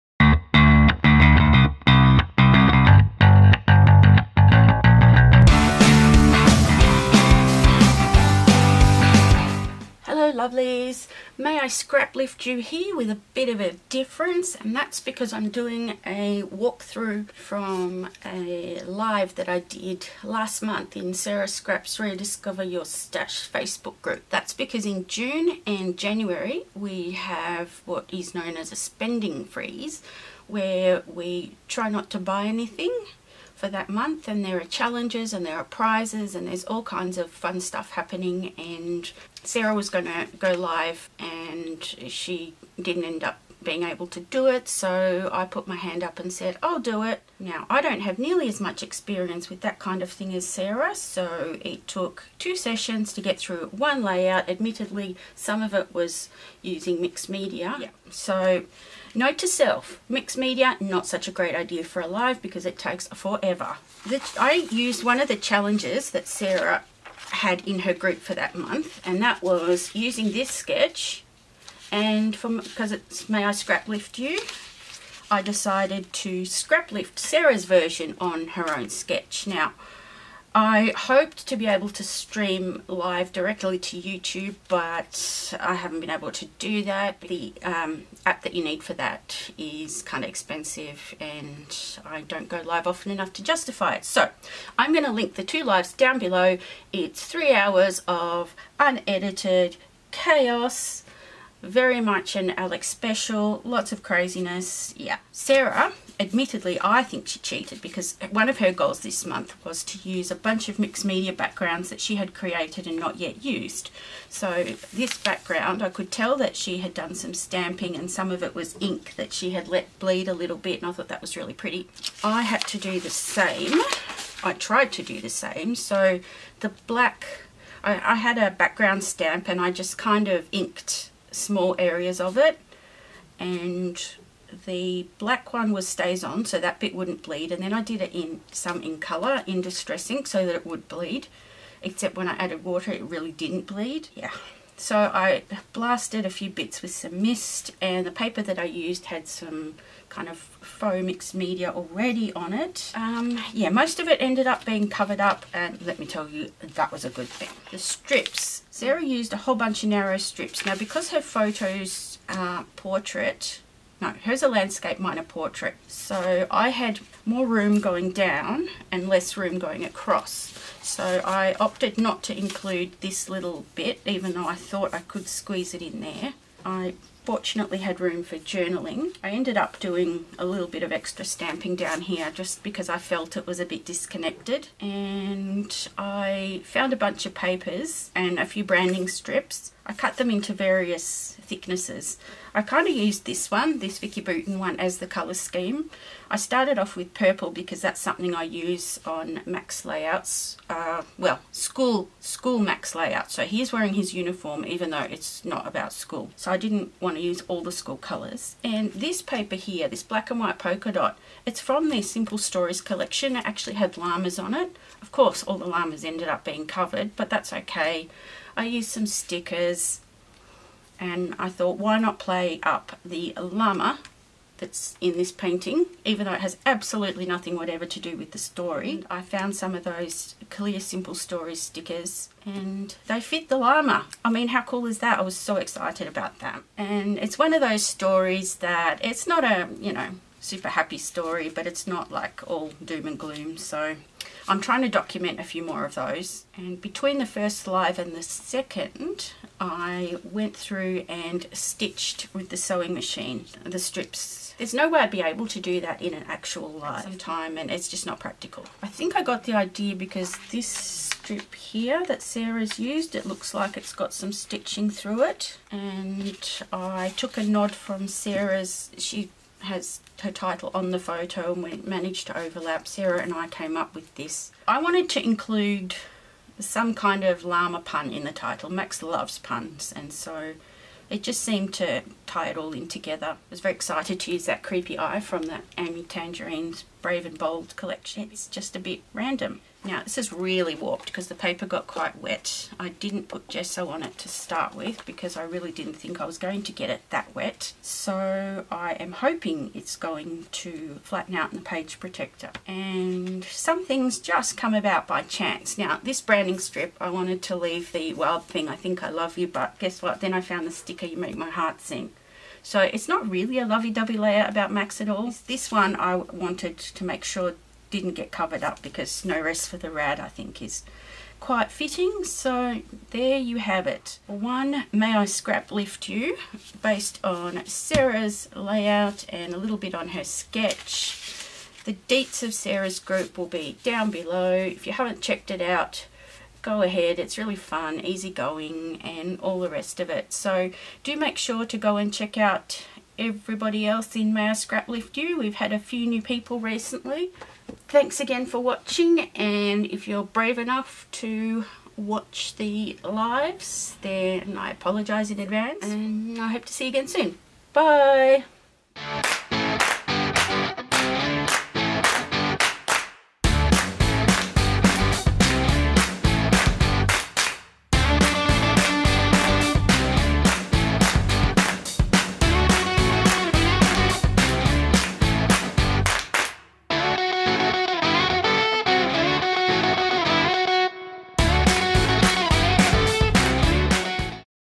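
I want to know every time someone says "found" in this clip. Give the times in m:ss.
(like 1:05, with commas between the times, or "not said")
3:06, 3:49, 5:10.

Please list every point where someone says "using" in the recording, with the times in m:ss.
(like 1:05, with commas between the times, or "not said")
0:56, 1:09.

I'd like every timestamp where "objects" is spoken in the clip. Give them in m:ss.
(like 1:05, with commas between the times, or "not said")
not said.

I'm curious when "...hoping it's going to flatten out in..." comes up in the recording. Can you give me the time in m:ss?
4:59.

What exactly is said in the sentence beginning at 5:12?
So it's not really a lovey-dovey layer about Max at all.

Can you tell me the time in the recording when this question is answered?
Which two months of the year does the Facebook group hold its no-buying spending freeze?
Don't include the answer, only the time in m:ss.
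0:25.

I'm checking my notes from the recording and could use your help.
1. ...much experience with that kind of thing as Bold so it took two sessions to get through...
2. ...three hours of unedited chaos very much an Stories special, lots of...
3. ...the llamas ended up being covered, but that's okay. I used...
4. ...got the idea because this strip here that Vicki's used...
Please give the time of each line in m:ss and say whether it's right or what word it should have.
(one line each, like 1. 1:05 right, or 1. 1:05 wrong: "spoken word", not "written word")
1. 0:48 wrong: "Sarah", not "Bold"
2. 1:37 wrong: "Alex", not "Stories"
3. 3:35 right
4. 4:19 wrong: "Sarah", not "Vicki".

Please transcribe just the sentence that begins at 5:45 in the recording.
We've had a few new people recently.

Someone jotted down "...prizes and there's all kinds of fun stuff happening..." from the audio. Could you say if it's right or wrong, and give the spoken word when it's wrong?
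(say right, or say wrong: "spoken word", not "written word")
right.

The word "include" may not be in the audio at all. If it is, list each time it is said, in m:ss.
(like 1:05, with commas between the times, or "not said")
2:52, 4:35.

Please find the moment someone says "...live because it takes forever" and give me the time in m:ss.
1:02.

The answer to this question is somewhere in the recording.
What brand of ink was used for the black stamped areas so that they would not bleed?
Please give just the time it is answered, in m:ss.
2:15.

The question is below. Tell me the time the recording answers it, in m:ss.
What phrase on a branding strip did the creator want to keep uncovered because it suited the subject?
5:19.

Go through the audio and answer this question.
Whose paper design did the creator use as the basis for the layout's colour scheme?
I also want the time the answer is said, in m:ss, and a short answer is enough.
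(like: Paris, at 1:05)
Vicki Boutin, at 3:13.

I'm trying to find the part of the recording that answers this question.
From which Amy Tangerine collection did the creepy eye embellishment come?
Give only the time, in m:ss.
4:47.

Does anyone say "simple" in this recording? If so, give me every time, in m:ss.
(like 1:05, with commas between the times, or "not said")
3:32, 3:50.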